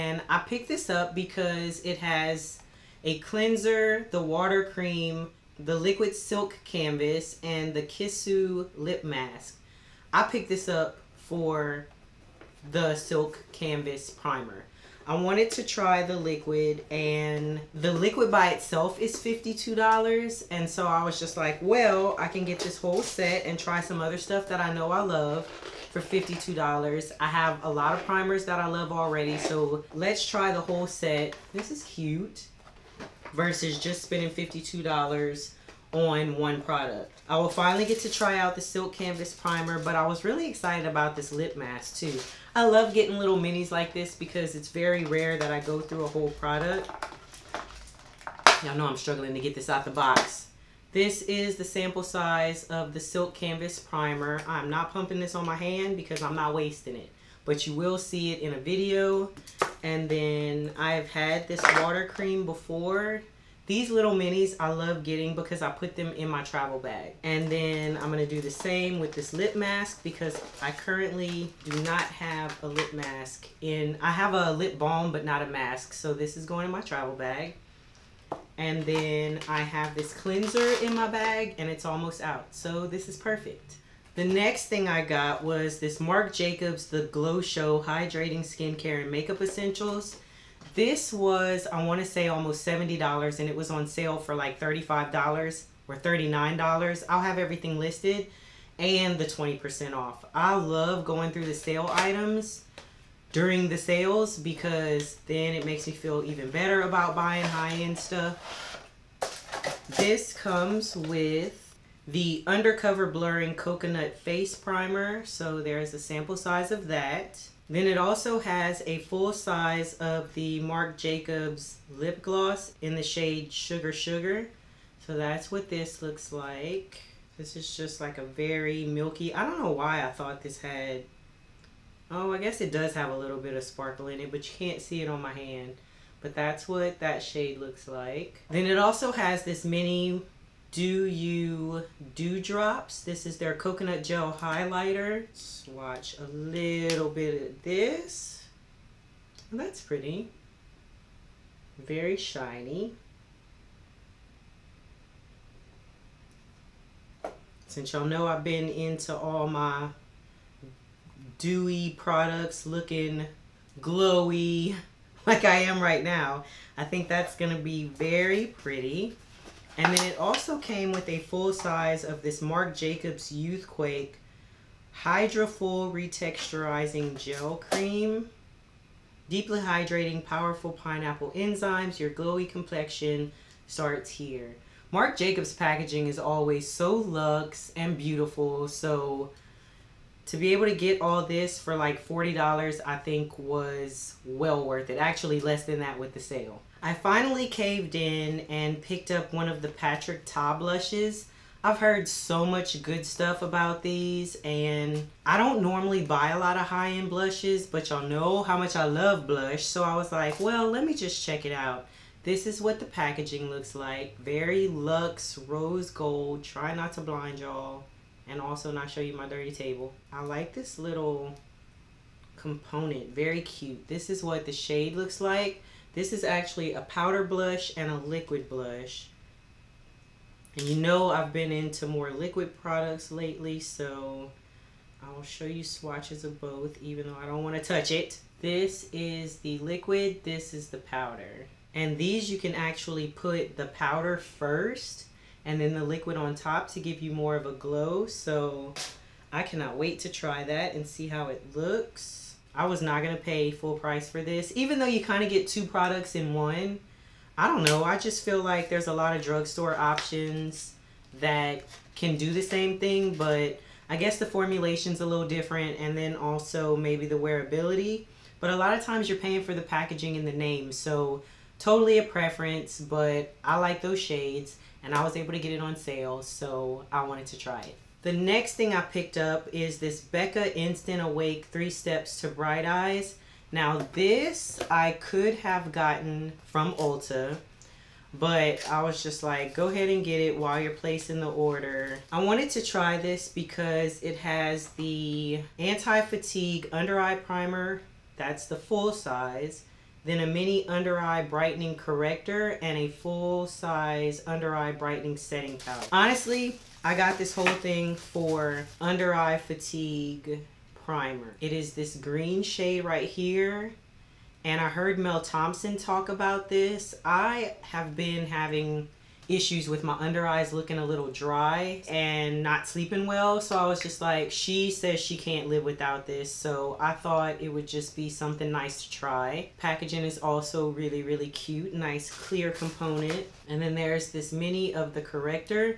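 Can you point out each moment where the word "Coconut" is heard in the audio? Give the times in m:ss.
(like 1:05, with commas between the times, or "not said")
1:53, 2:23.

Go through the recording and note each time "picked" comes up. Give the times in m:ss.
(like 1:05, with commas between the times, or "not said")
0:00, 0:10, 3:18, 4:38.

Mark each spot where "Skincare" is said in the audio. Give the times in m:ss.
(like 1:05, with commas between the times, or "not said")
1:28.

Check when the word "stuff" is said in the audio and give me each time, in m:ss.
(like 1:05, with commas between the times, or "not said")
0:24, 1:47, 3:23.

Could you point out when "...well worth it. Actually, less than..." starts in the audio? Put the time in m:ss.
3:14.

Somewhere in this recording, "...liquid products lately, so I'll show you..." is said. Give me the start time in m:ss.
3:52.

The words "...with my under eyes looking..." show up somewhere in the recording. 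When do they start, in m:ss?
5:19.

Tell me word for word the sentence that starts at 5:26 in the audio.
So I thought it would just be something nice to try.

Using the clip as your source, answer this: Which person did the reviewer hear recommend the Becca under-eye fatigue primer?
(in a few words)
Mel Thompson.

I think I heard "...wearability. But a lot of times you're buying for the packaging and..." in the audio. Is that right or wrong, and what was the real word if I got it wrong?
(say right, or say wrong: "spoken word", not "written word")
wrong: "paying", not "buying".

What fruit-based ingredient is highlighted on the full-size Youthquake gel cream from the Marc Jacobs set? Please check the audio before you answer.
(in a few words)
pineapple enzymes.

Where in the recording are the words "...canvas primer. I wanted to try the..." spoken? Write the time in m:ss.
0:13.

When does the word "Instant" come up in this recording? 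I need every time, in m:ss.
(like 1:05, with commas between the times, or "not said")
4:40.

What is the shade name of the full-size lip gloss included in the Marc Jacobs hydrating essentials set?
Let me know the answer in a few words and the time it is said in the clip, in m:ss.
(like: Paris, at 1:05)
Sugar Sugar, at 2:03.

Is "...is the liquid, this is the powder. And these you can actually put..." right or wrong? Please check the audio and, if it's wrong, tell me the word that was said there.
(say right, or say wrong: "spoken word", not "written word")
right.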